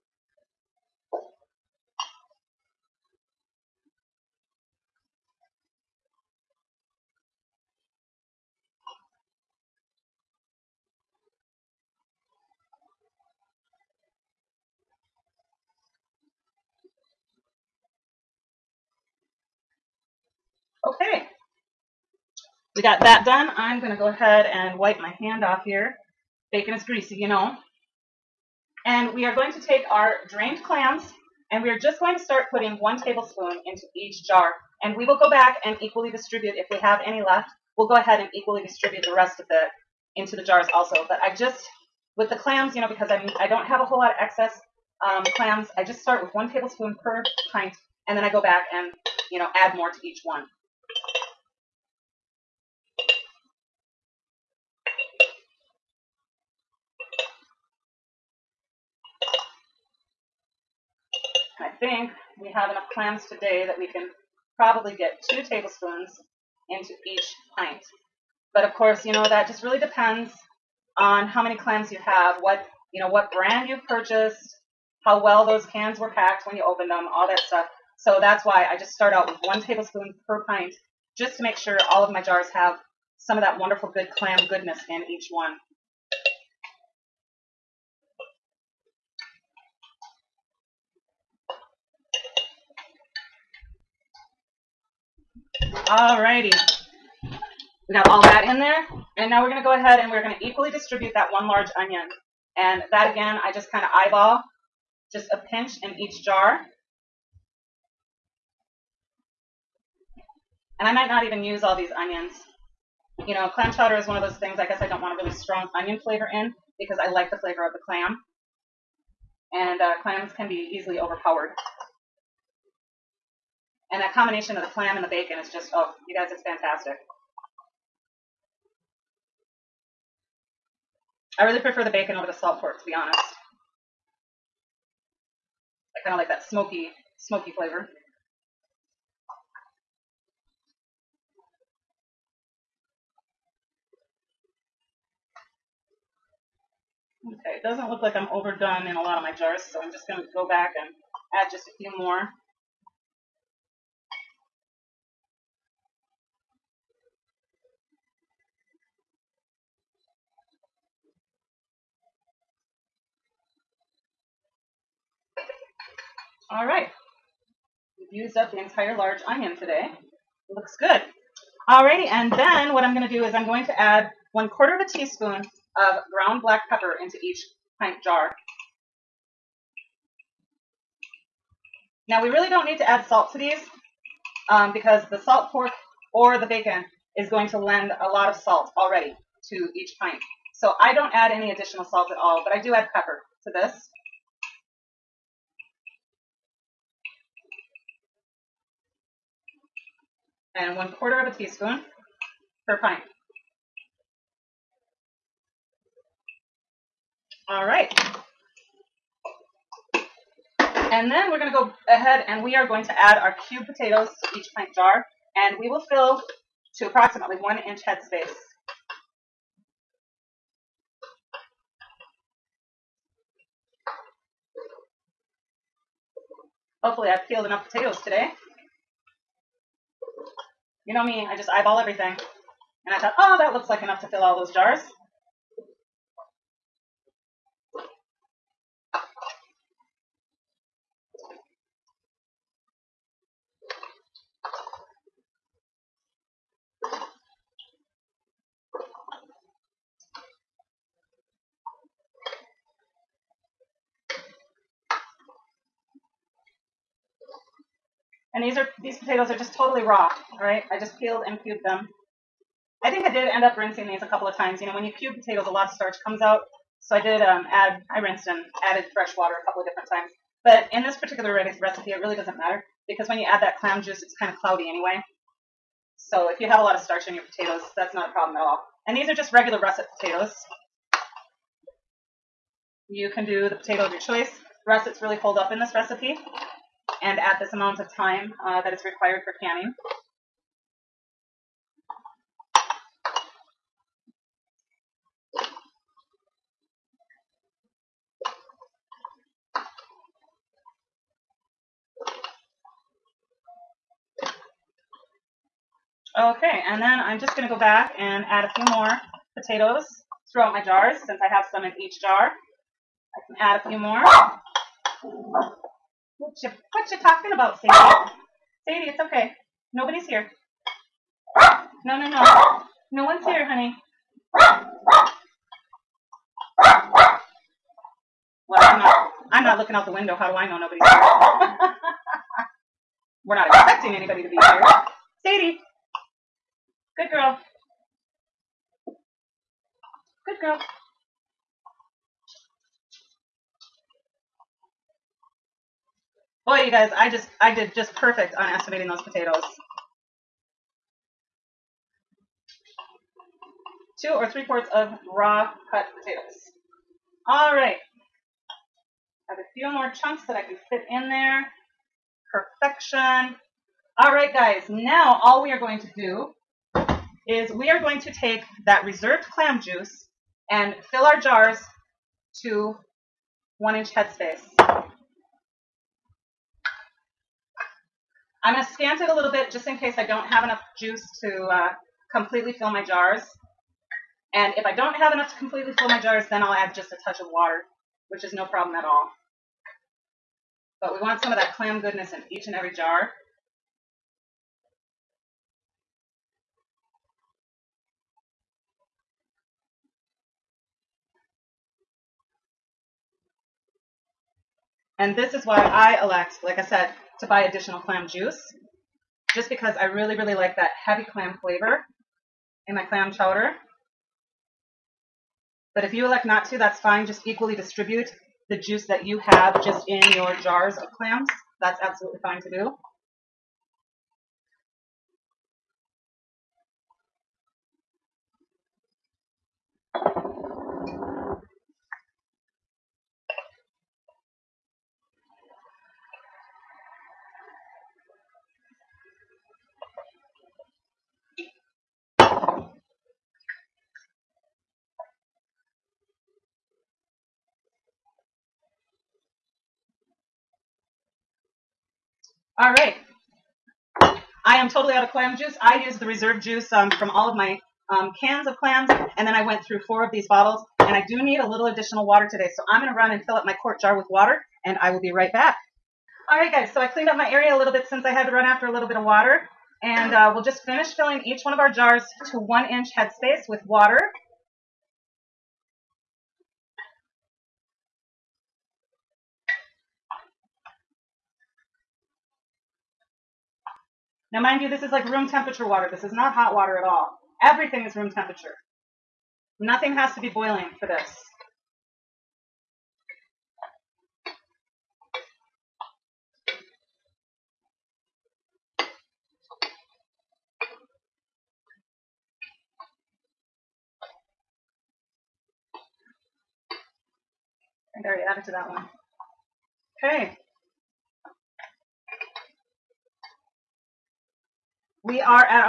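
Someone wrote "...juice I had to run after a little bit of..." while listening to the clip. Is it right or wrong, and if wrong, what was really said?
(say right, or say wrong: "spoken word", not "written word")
wrong: "since", not "juice".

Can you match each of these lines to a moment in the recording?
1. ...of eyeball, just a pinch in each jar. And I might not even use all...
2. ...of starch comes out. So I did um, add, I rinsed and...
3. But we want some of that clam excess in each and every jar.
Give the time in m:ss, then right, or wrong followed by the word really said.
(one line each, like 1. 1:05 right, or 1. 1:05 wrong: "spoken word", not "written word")
1. 1:43 right
2. 4:25 right
3. 6:30 wrong: "goodness", not "excess".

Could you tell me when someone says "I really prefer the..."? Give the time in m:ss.
2:11.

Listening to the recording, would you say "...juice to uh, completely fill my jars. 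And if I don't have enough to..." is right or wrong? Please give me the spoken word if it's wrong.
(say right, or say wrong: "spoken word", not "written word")
right.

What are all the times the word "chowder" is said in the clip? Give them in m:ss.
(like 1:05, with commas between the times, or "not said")
1:53, 6:53.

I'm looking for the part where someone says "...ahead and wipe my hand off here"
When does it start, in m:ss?
0:24.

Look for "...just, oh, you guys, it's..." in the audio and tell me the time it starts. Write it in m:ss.
2:05.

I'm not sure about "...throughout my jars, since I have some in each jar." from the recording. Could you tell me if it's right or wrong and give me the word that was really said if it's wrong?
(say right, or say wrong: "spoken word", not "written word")
right.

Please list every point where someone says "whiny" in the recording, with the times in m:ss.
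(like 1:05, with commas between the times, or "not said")
not said.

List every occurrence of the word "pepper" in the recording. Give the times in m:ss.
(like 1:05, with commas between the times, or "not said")
2:56, 3:12.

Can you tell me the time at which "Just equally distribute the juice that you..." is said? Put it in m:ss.
6:57.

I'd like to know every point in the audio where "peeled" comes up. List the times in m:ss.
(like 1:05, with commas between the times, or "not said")
3:47, 4:20.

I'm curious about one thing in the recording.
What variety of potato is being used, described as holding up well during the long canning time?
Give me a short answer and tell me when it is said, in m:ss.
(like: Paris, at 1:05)
russet, at 4:39.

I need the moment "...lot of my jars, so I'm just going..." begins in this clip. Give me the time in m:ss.
2:29.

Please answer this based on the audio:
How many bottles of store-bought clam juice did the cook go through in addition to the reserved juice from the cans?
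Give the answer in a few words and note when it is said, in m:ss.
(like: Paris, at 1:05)
4, at 7:39.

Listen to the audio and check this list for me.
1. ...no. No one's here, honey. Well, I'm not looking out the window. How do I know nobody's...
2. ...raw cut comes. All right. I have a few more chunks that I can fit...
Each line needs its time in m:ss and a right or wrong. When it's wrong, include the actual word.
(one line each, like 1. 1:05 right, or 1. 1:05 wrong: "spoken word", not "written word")
1. 5:22 right
2. 5:55 wrong: "potatoes", not "comes".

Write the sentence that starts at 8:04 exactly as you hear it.
Now, mind you, this is like room temperature water.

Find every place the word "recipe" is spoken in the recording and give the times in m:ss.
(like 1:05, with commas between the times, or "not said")
4:31, 4:45.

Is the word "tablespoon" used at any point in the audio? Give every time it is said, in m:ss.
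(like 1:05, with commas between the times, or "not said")
0:32, 0:46, 1:05, 1:19.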